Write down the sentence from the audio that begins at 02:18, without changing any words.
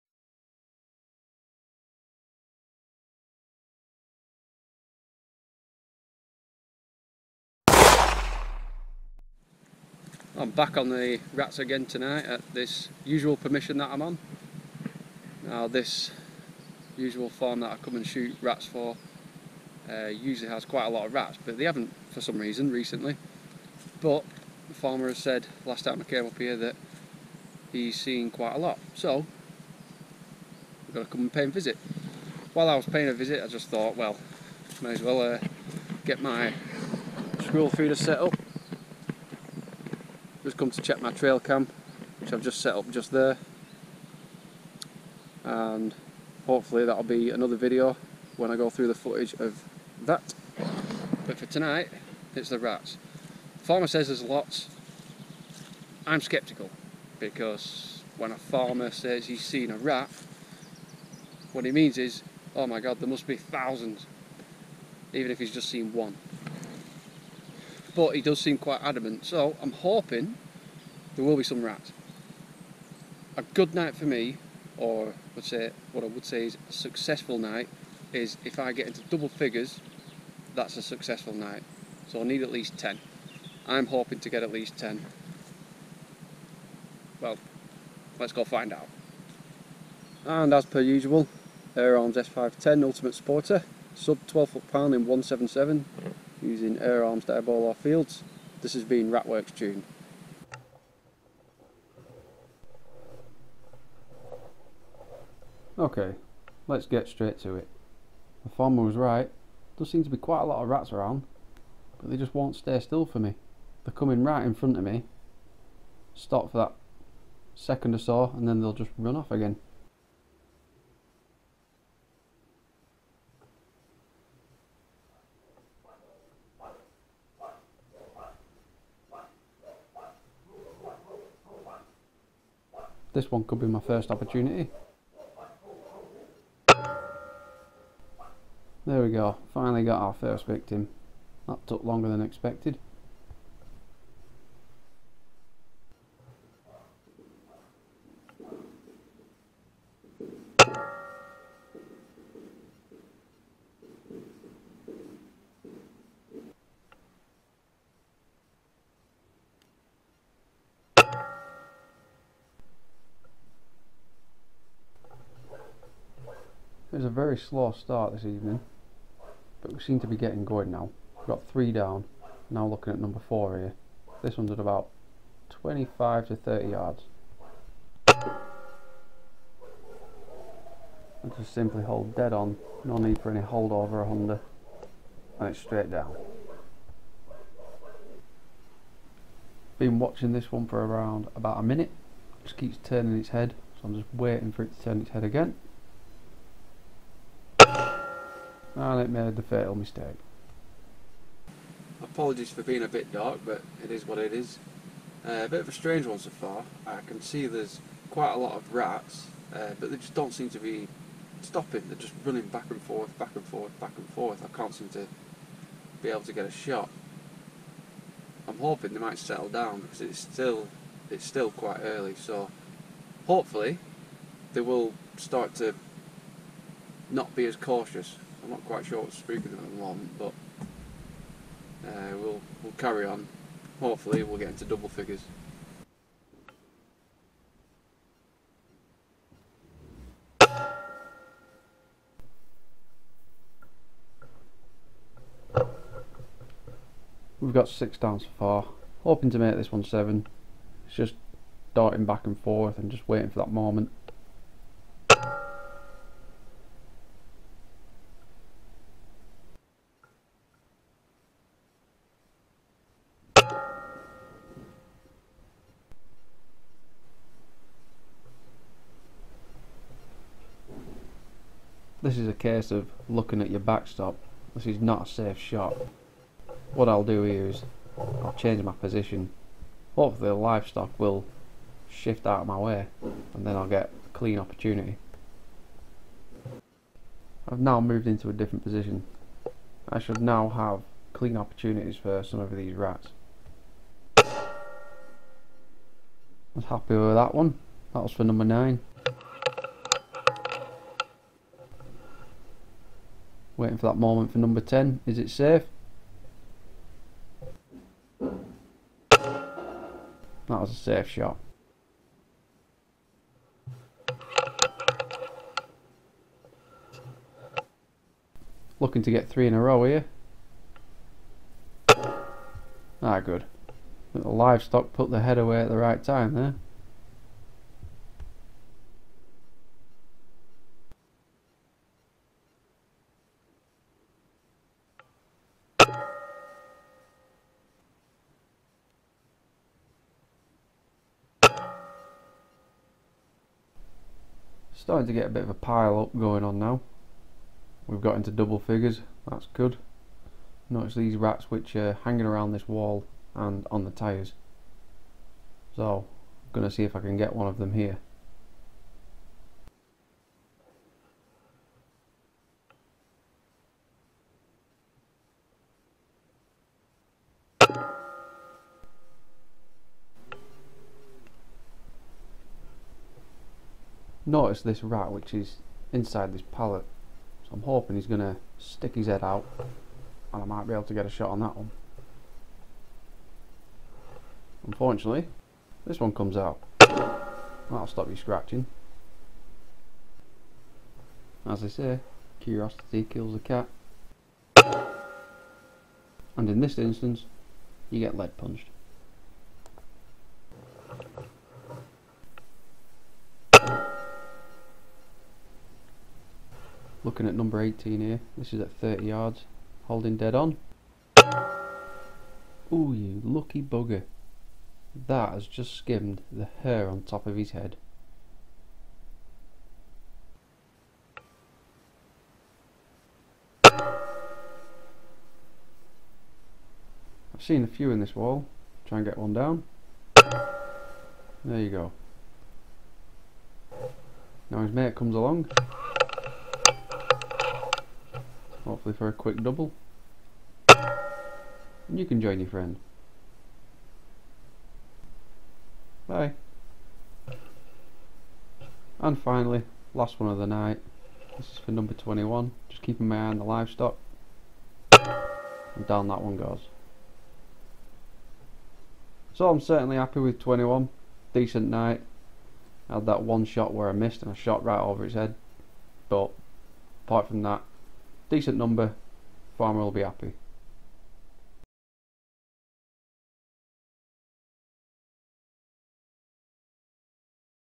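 There we go, finally got our first victim.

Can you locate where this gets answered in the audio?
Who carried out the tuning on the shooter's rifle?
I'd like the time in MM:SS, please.
01:39.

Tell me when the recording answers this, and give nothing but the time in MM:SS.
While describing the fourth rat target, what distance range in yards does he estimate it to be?
02:55.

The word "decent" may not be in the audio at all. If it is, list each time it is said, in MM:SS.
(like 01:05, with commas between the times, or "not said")
07:41, 07:48.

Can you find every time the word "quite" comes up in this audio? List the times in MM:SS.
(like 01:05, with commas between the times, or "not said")
00:20, 00:28, 01:08, 01:50, 03:28, 03:41, 03:48.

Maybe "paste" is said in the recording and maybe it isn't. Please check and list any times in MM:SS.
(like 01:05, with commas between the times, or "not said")
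not said.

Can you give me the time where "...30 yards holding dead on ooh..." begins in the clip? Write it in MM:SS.
06:48.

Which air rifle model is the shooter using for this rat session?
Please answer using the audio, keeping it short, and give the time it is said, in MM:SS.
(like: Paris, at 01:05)
Air Arms S510 Ultimate Sporter, at 01:31.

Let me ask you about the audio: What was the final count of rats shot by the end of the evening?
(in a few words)
21.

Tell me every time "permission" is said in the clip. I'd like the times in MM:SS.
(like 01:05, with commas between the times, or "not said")
00:13.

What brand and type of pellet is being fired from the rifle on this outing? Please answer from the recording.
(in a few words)
Air Arms Diabolo Fields.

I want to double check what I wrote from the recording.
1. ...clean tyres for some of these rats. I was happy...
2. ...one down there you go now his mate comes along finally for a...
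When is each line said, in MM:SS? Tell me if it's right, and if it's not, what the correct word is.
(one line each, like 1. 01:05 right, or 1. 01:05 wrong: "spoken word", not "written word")
1. 04:51 wrong: "opportunities", not "tyres"
2. 07:09 wrong: "hopefully", not "finally".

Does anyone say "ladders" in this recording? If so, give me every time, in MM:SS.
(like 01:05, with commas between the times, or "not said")
not said.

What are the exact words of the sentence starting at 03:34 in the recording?
I can't seem to be able to get a shot.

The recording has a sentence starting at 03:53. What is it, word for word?
Hopefully, we'll get into double figures.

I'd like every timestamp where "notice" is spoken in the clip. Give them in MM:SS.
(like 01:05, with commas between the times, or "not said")
05:50, 06:14.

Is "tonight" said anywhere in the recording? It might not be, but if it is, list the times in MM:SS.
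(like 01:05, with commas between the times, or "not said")
00:11, 00:51.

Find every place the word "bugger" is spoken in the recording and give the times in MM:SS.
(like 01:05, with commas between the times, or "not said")
06:53.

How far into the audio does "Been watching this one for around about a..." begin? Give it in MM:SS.
03:09.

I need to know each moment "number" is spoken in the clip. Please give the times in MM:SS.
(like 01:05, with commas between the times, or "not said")
02:52, 04:58, 05:04, 06:47, 07:31, 07:48.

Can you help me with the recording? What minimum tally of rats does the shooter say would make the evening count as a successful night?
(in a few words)
10.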